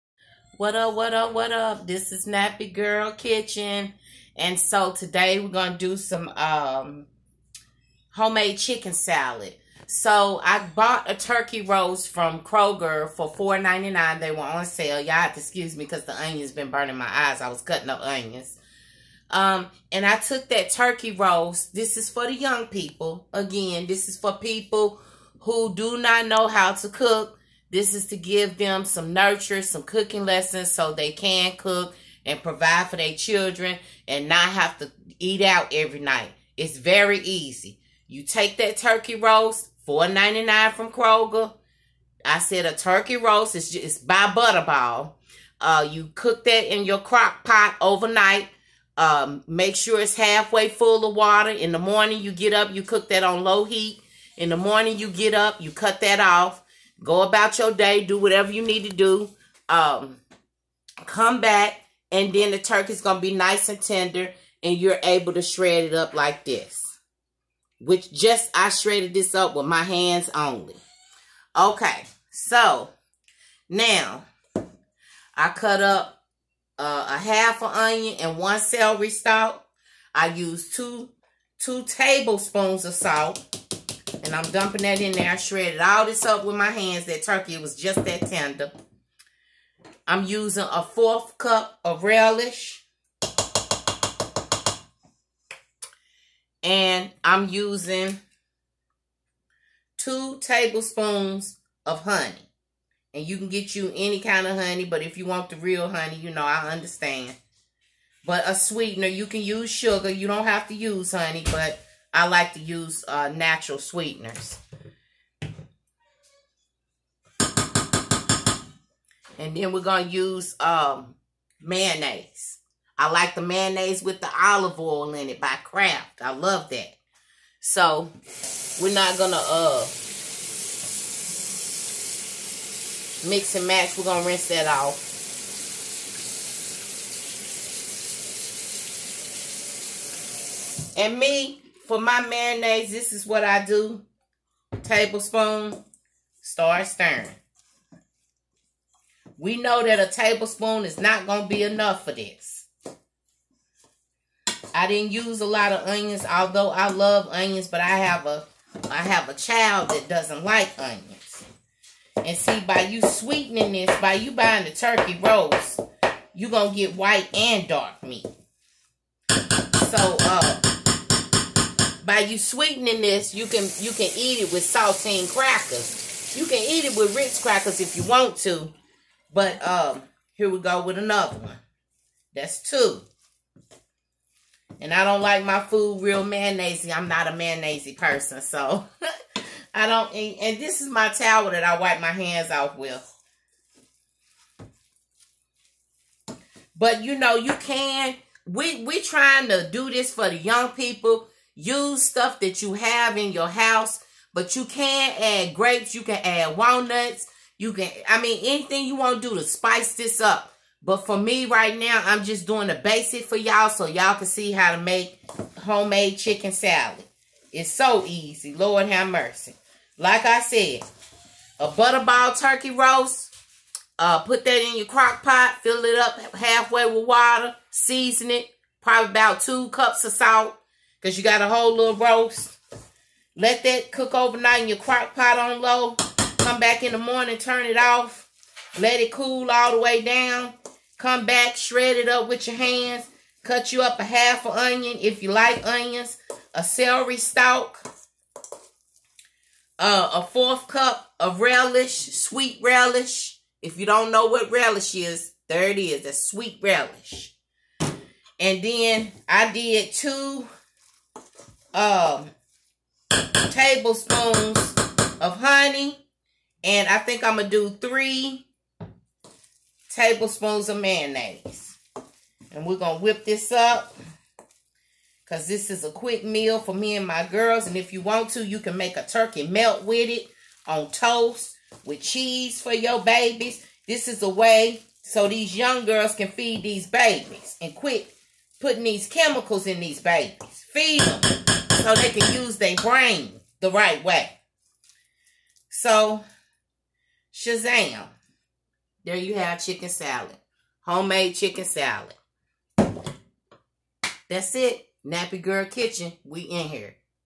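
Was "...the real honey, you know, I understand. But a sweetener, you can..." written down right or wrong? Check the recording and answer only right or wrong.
right.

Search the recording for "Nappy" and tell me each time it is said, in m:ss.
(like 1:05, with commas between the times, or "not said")
0:02, 5:05.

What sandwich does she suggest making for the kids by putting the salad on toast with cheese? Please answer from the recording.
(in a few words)
turkey melt.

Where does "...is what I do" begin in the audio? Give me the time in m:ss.
2:23.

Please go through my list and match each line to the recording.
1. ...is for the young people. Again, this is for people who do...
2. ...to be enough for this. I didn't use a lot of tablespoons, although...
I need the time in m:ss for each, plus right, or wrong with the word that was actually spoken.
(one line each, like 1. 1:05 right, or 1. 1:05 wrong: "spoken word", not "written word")
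1. 0:21 right
2. 2:31 wrong: "onions", not "tablespoons".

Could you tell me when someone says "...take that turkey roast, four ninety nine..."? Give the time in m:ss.
0:38.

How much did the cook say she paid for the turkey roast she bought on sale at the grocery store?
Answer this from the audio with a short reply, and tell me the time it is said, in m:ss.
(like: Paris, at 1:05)
$4.99, at 0:13.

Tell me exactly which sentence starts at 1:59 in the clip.
And then we're going to use um, mayonnaise.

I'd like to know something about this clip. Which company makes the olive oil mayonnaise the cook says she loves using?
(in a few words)
Kraft.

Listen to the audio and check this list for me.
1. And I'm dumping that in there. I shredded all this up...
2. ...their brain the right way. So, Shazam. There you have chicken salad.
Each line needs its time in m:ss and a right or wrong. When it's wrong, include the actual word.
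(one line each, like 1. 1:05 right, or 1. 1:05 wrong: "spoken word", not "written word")
1. 1:24 right
2. 4:52 right.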